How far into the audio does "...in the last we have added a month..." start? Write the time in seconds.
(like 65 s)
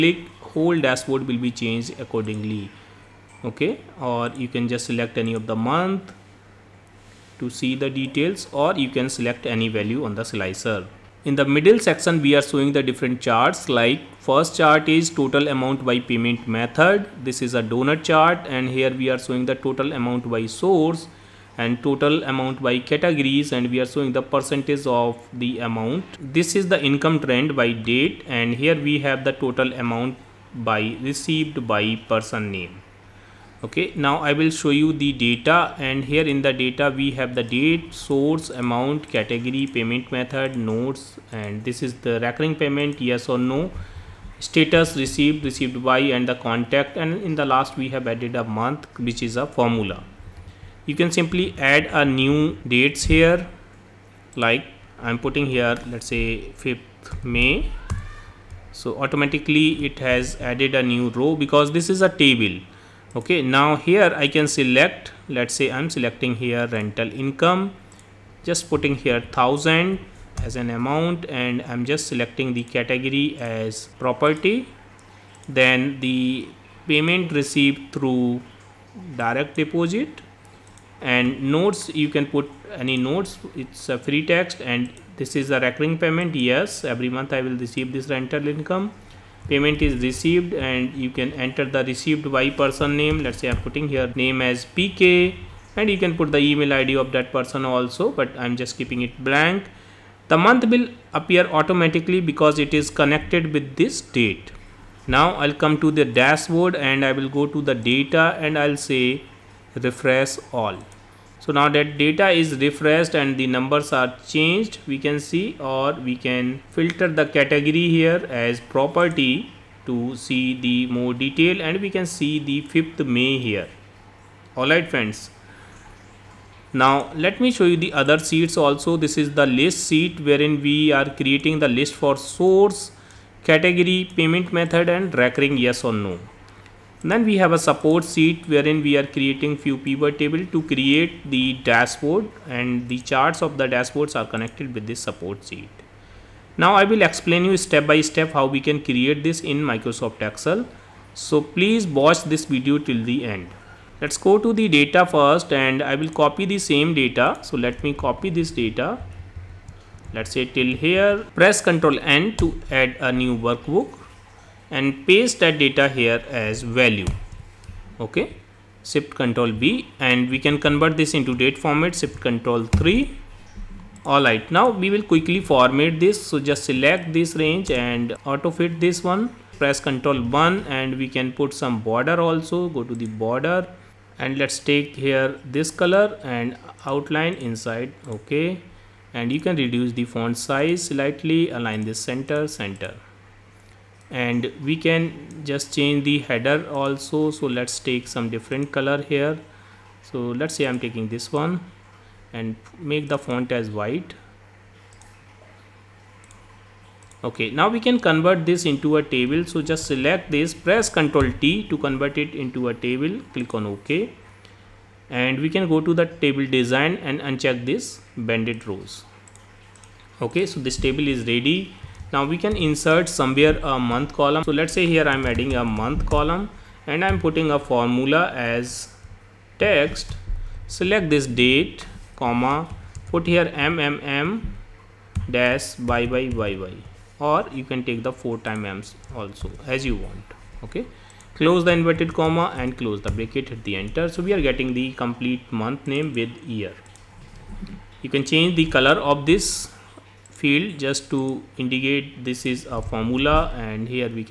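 47 s.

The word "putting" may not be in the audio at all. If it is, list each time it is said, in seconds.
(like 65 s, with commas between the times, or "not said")
55 s, 68 s, 93 s, 227 s.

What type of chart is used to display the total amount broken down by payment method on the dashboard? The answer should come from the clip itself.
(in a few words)
Doughnut chart.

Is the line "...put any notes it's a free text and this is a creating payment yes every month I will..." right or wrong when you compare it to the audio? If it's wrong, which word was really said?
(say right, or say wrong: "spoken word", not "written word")
wrong: "recurring", not "creating".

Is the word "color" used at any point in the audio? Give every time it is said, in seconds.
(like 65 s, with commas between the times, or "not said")
185 s, 198 s, 248 s.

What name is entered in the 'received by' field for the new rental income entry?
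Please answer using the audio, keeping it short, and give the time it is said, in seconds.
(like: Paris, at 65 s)
PK, at 94 s.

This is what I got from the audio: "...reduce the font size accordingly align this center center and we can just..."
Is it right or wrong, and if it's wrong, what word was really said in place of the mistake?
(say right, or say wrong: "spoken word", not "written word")
wrong: "slightly", not "accordingly".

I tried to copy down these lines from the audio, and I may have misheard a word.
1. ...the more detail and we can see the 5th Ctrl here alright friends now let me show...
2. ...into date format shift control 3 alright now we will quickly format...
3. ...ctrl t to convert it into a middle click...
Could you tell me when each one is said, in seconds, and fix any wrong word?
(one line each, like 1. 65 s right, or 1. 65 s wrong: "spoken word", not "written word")
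1. 120 s wrong: "May", not "Ctrl"
2. 171 s right
3. 210 s wrong: "table", not "middle".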